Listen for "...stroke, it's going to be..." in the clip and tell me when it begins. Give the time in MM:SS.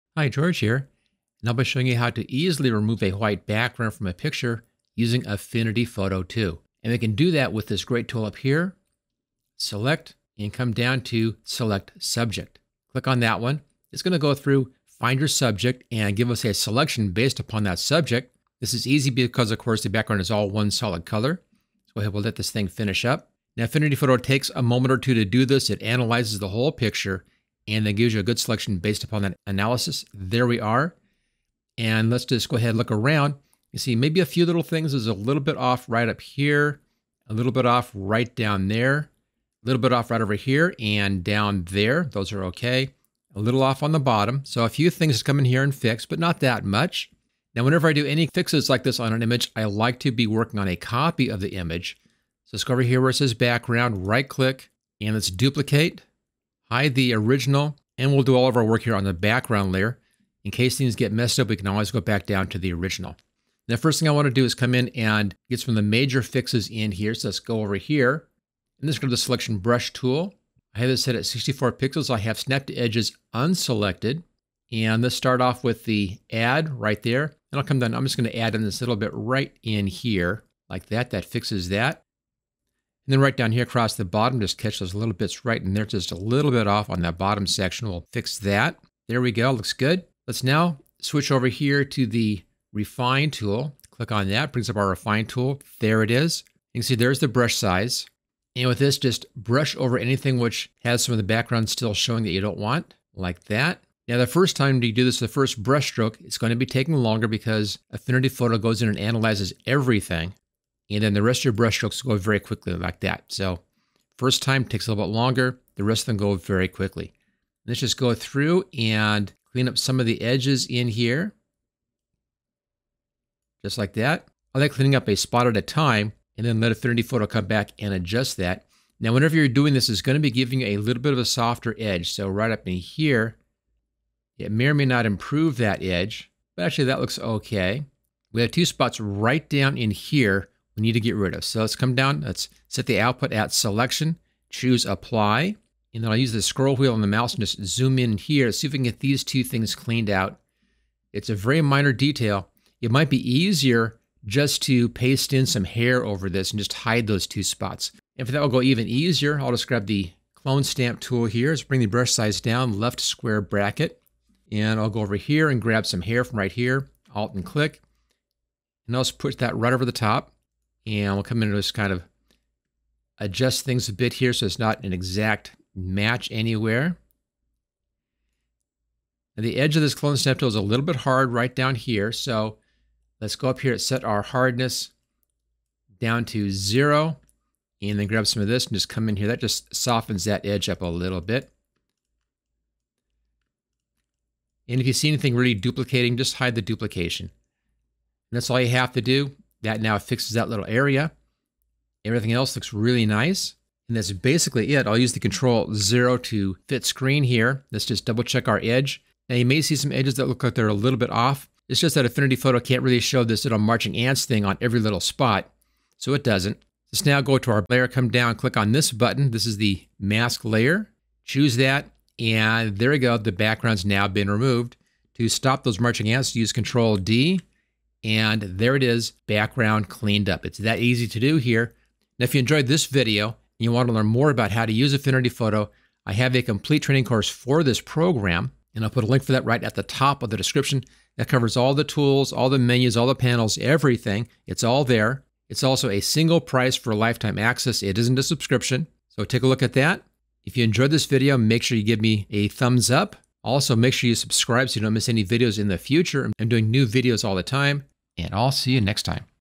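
01:45.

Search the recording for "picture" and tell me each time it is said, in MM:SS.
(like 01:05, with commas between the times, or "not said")
00:04, 00:26.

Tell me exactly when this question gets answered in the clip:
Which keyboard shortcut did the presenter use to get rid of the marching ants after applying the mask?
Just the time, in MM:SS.
03:46.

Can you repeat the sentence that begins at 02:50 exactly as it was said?
And we'll come in and just kind of adjust things a bit here so it's not an exact match anywhere.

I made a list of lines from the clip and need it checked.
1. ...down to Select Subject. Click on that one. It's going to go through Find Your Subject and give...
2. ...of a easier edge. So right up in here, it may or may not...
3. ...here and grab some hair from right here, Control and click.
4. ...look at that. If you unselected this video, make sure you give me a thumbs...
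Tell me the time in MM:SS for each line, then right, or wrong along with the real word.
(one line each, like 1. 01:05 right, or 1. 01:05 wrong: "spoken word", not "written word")
1. 00:10 right
2. 02:11 wrong: "softer", not "easier"
3. 02:45 wrong: "Alt", not "Control"
4. 04:09 wrong: "enjoyed", not "unselected".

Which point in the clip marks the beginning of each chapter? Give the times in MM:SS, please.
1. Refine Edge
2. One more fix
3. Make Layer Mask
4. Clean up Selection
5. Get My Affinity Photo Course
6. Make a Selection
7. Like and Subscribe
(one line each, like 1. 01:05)
1. 01:30
2. 02:25
3. 03:21
4. 00:52
5. 03:55
6. 00:10
7. 04:10.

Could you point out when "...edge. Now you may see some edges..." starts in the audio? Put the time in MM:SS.
03:28.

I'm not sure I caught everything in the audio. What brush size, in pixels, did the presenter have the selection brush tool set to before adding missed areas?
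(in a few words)
64 pixels.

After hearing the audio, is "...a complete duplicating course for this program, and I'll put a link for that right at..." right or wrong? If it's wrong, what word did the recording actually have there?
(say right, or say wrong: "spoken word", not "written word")
wrong: "training", not "duplicating".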